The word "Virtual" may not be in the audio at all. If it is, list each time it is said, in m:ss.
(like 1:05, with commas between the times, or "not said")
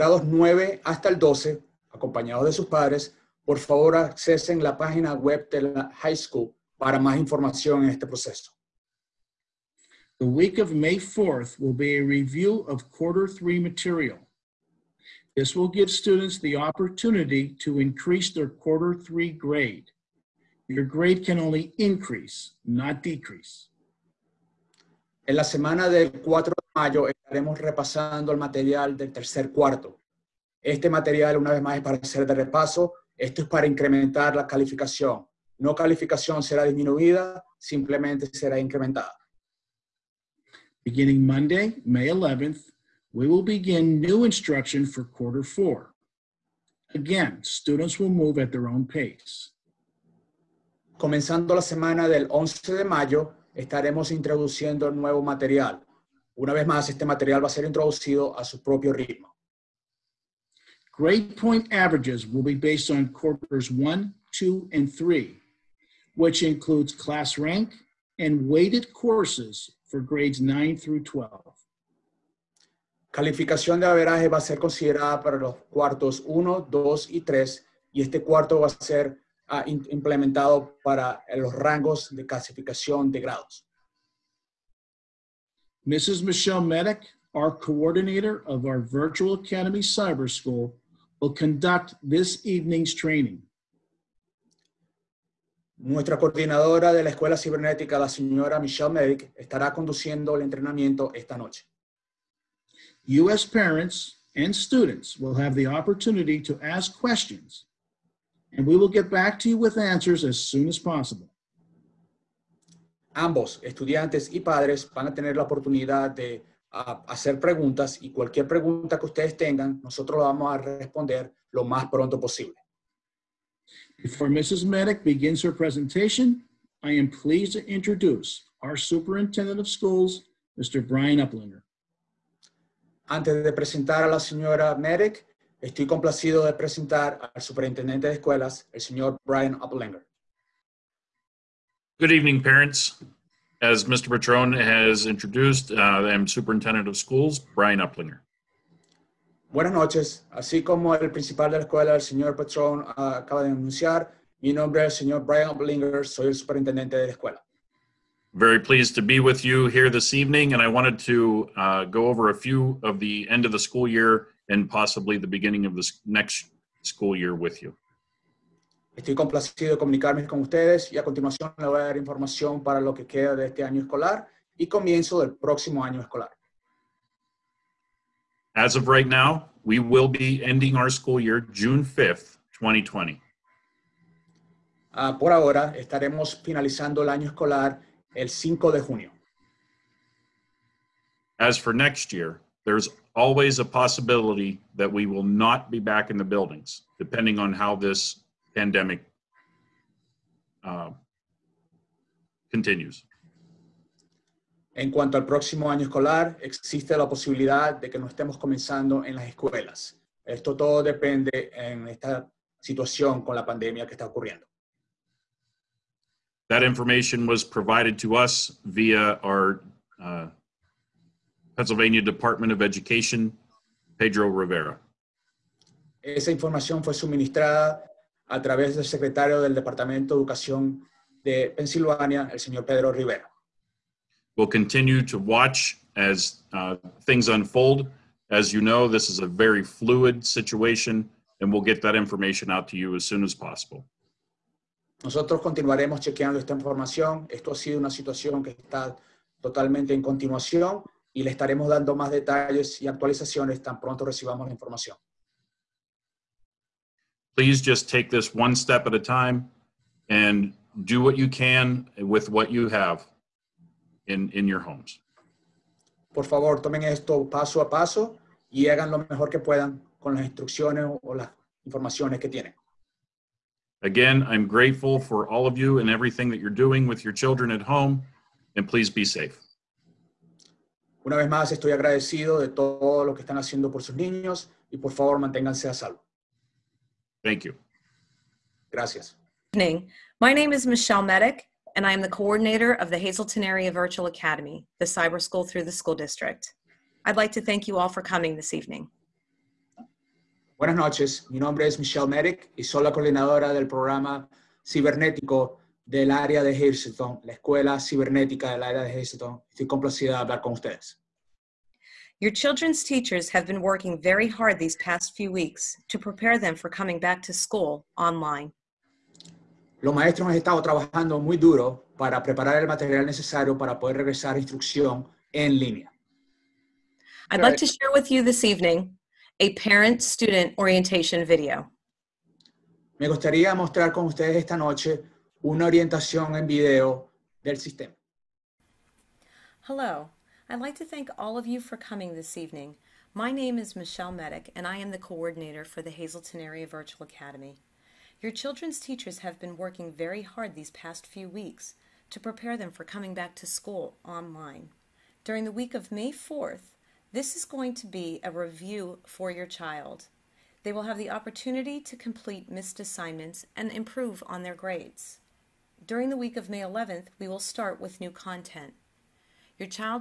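1:28, 4:53, 5:46.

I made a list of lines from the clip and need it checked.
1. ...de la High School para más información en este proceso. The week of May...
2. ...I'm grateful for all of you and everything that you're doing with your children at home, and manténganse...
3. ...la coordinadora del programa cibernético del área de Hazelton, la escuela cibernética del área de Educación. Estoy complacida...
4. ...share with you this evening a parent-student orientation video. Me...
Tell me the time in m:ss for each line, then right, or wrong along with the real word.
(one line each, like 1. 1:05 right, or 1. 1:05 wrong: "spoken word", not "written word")
1. 0:05 right
2. 4:34 wrong: "please", not "manténganse"
3. 5:02 wrong: "Hazelton", not "Educación"
4. 5:27 right.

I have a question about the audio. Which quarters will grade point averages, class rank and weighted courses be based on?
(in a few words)
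1, 2, and 3.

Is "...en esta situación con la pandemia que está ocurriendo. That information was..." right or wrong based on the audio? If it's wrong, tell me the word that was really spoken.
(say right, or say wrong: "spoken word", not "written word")
right.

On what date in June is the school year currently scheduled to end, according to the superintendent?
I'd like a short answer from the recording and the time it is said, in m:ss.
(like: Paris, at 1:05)
June 5th, 2020, at 3:01.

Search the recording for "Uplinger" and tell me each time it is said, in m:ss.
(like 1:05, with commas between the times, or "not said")
2:11, 2:27, 2:35.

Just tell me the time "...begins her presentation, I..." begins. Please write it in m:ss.
2:05.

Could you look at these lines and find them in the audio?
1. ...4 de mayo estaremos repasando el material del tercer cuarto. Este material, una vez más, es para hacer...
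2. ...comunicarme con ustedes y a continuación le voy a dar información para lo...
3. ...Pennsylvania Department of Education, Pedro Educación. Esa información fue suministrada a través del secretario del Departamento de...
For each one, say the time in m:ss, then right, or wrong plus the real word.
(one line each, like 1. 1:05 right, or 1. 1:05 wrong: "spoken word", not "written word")
1. 0:26 right
2. 2:49 right
3. 3:41 wrong: "Rivera", not "Educación".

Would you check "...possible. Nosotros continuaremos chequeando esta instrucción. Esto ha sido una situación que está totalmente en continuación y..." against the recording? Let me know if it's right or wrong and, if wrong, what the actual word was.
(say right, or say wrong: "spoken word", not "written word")
wrong: "información", not "instrucción".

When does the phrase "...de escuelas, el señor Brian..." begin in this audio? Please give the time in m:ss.
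2:18.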